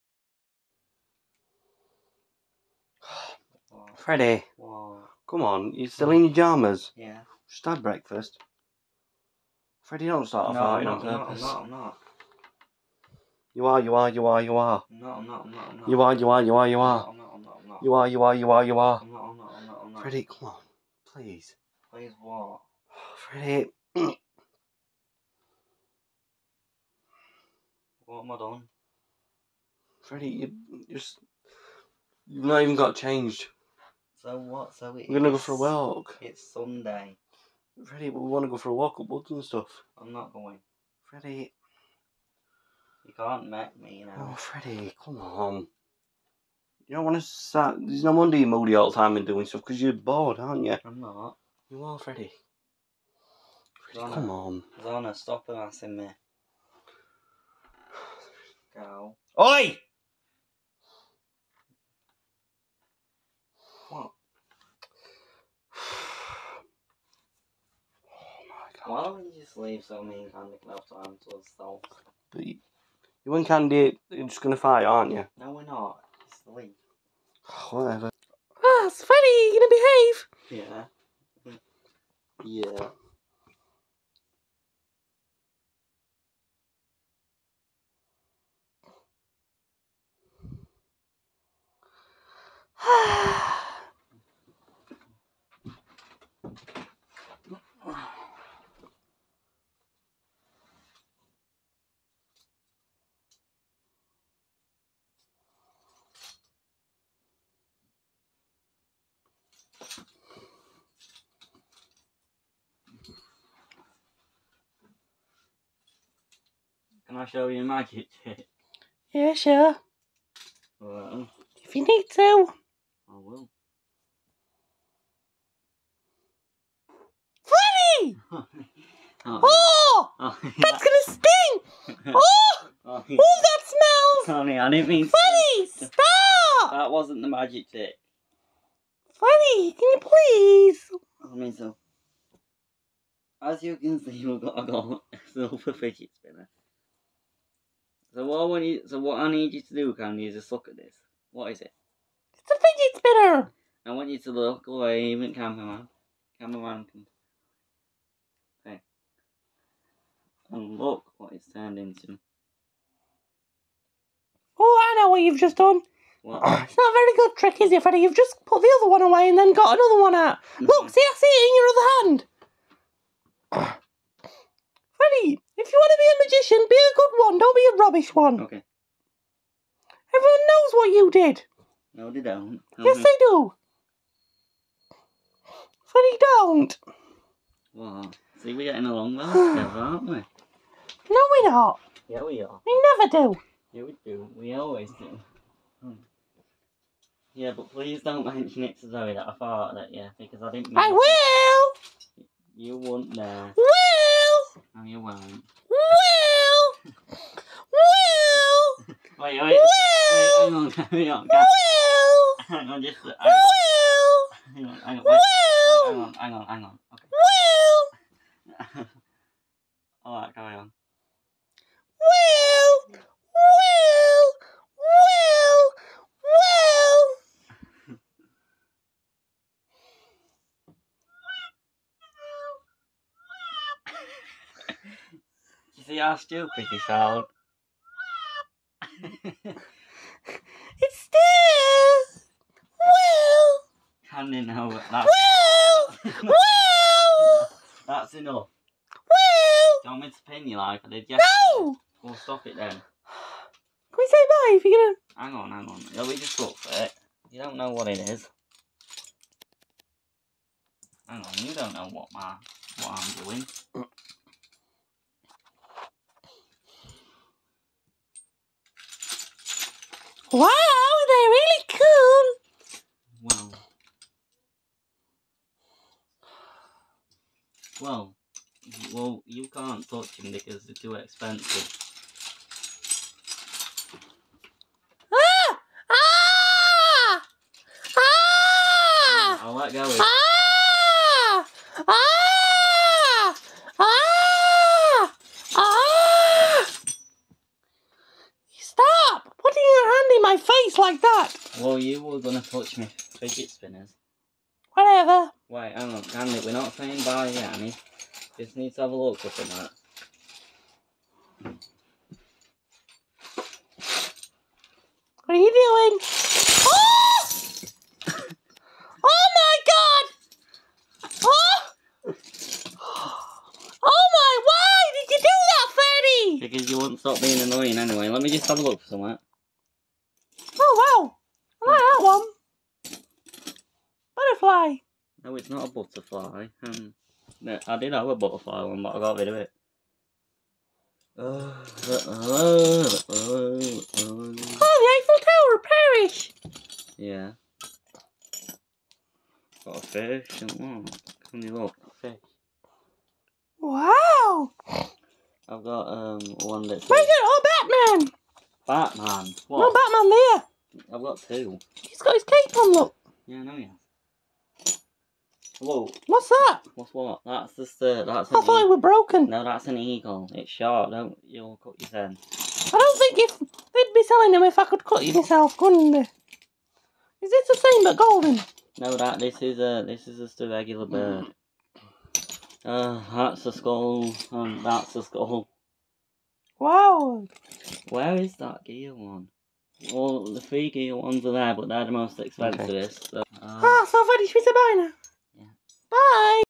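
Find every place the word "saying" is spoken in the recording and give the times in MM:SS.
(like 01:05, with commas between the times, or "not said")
05:06.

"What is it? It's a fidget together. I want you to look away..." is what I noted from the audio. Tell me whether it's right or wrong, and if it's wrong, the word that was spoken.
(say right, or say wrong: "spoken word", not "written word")
wrong: "spinner", not "together".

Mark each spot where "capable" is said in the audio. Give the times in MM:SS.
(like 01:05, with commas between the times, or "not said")
not said.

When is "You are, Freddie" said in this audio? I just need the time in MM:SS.
00:51.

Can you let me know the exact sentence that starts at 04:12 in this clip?
Can we say bye if you're gonna?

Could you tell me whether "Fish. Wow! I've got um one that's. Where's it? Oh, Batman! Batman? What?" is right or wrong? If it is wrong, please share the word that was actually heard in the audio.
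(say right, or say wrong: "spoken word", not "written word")
right.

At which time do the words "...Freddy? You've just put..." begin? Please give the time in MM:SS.
02:47.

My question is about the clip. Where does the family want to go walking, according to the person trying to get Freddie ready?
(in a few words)
up woods.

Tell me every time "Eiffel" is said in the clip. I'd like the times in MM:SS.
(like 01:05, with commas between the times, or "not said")
05:44.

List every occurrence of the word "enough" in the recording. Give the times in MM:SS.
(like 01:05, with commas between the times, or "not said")
01:10, 04:08.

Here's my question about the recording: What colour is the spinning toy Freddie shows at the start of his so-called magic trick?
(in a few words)
silver.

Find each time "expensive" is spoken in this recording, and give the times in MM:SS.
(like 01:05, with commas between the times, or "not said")
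04:40, 06:32.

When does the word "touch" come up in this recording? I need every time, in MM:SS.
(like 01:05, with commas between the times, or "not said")
04:39, 05:02.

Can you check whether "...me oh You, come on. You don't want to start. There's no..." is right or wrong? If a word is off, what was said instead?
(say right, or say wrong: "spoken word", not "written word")
wrong: "Freddie", not "You".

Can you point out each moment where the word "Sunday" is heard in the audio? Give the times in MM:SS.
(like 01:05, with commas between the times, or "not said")
00:36.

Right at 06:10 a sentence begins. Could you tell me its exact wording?
Don't you'll cut your I don't think if they'd be selling them if I could cut you myself, couldn't they?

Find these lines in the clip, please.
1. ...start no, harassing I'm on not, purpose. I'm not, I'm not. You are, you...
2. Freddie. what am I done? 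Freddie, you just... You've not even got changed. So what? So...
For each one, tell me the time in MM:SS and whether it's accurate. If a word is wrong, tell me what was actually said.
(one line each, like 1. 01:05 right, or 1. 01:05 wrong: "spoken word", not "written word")
1. 00:10 wrong: "farting", not "harassing"
2. 00:23 right.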